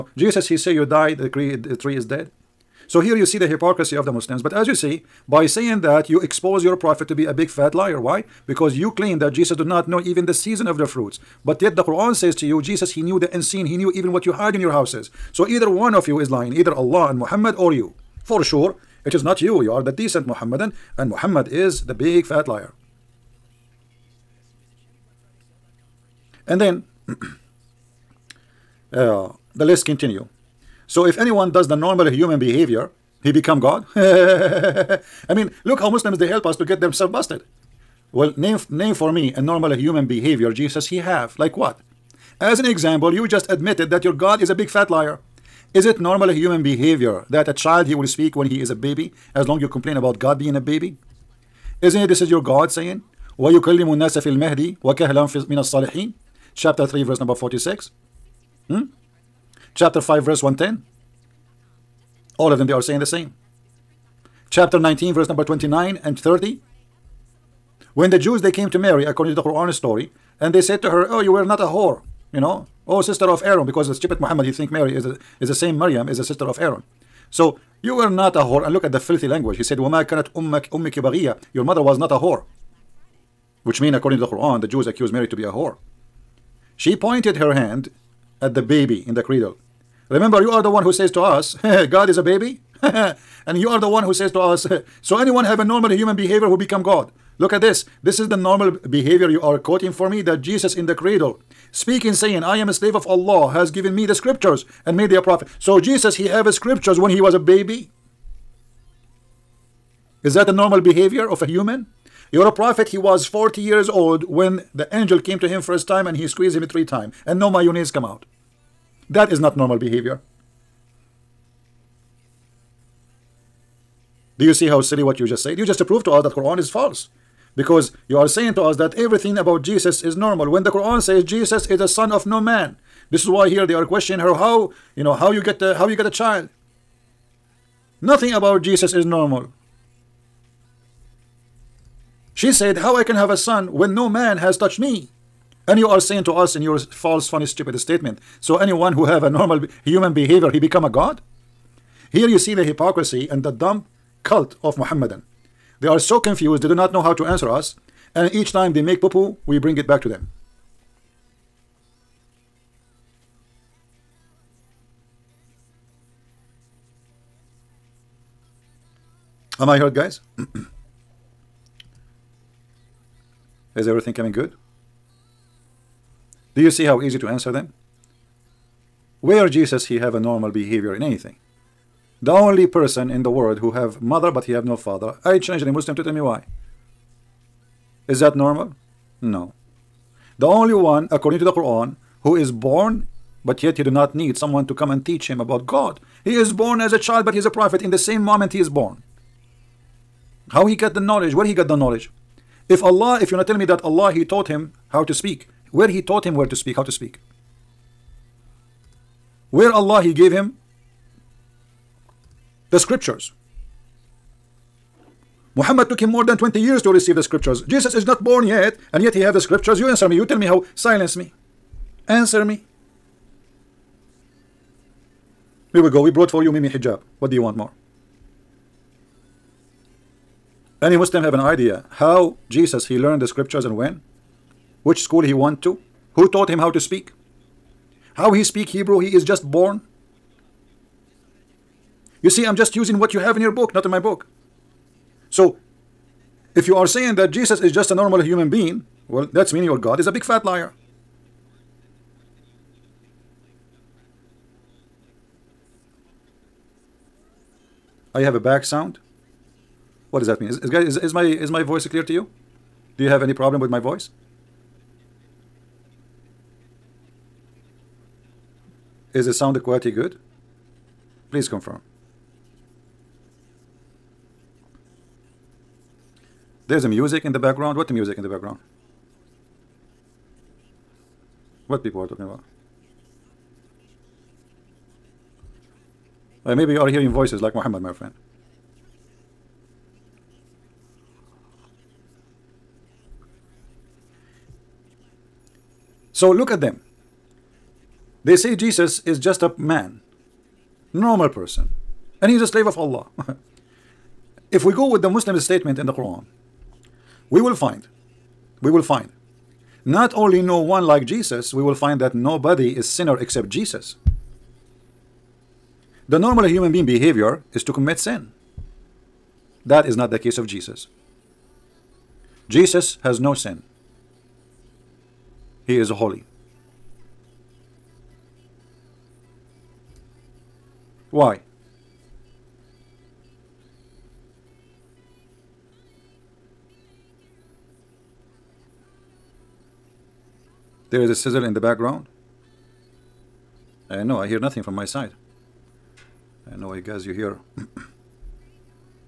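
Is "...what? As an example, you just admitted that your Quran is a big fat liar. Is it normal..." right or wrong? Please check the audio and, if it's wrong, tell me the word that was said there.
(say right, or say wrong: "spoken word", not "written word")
wrong: "God", not "Quran".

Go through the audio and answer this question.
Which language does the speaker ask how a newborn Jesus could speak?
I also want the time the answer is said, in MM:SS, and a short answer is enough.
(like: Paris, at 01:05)
Hebrew, at 03:58.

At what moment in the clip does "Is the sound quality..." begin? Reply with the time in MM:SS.
04:29.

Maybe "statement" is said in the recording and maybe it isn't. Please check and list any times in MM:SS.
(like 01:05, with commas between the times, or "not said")
02:27, 05:05.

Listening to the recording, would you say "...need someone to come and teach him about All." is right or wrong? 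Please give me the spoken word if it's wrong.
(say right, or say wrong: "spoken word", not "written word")
wrong: "God", not "All".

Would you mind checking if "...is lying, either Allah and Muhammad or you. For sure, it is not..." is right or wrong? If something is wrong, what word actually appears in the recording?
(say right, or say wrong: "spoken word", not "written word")
right.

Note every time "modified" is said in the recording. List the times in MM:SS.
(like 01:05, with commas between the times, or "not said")
not said.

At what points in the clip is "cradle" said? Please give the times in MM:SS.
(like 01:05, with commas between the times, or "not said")
01:29, 01:40.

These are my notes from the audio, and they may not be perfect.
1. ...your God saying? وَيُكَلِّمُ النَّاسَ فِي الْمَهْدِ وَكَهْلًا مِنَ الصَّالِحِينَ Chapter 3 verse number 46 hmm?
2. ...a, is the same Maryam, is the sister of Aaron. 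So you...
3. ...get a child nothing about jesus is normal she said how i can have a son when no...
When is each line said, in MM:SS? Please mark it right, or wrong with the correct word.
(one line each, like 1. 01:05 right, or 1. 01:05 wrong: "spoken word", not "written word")
1. 00:52 right
2. 01:15 right
3. 02:15 right.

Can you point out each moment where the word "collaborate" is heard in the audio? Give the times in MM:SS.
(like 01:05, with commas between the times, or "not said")
not said.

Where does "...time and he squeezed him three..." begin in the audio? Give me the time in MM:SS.
01:55.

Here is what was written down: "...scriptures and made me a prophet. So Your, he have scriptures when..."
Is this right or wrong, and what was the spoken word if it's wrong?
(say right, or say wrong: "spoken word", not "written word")
wrong: "Jesus", not "Your".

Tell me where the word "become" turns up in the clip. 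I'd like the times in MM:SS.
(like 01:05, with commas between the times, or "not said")
00:33, 01:36, 02:30.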